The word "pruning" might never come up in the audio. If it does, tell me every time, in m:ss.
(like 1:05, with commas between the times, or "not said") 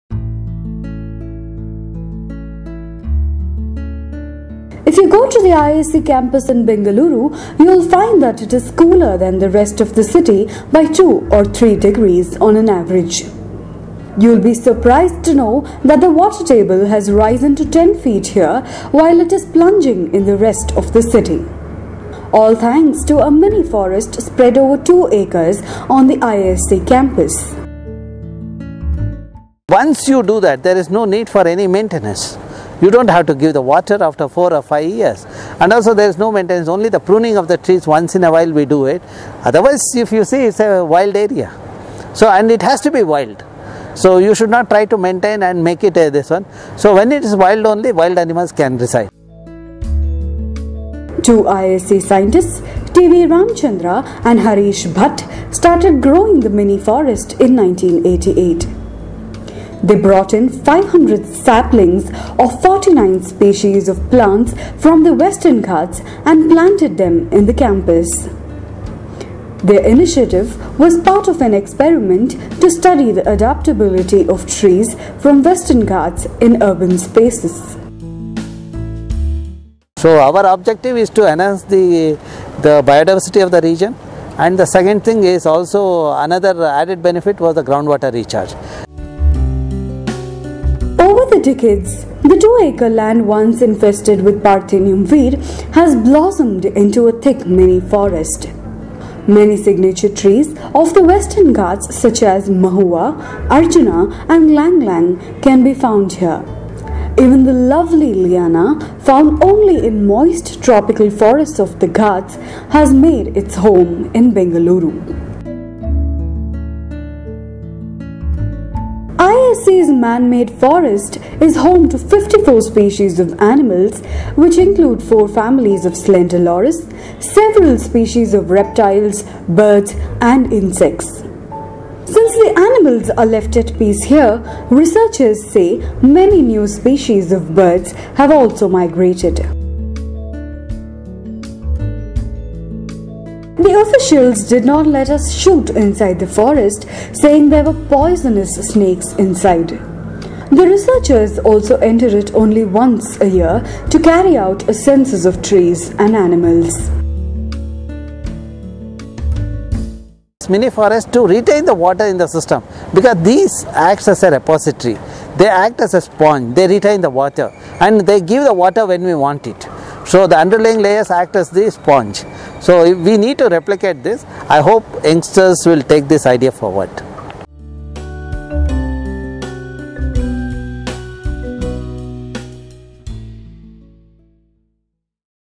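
0:36.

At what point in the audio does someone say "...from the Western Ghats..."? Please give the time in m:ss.
1:04.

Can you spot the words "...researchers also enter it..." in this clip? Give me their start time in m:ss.
2:30.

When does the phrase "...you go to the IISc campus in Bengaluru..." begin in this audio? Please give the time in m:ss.
0:04.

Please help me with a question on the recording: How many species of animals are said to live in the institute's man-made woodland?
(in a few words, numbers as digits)
54.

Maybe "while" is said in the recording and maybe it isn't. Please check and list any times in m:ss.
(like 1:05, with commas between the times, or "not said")
0:18, 0:38.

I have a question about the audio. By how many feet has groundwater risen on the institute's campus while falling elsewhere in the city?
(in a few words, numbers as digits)
10 feet.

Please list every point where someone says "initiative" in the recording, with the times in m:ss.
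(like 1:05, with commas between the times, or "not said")
1:09.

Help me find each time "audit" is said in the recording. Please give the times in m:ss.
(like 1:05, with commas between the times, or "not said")
not said.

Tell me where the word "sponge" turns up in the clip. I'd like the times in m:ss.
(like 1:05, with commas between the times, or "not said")
2:46, 2:51.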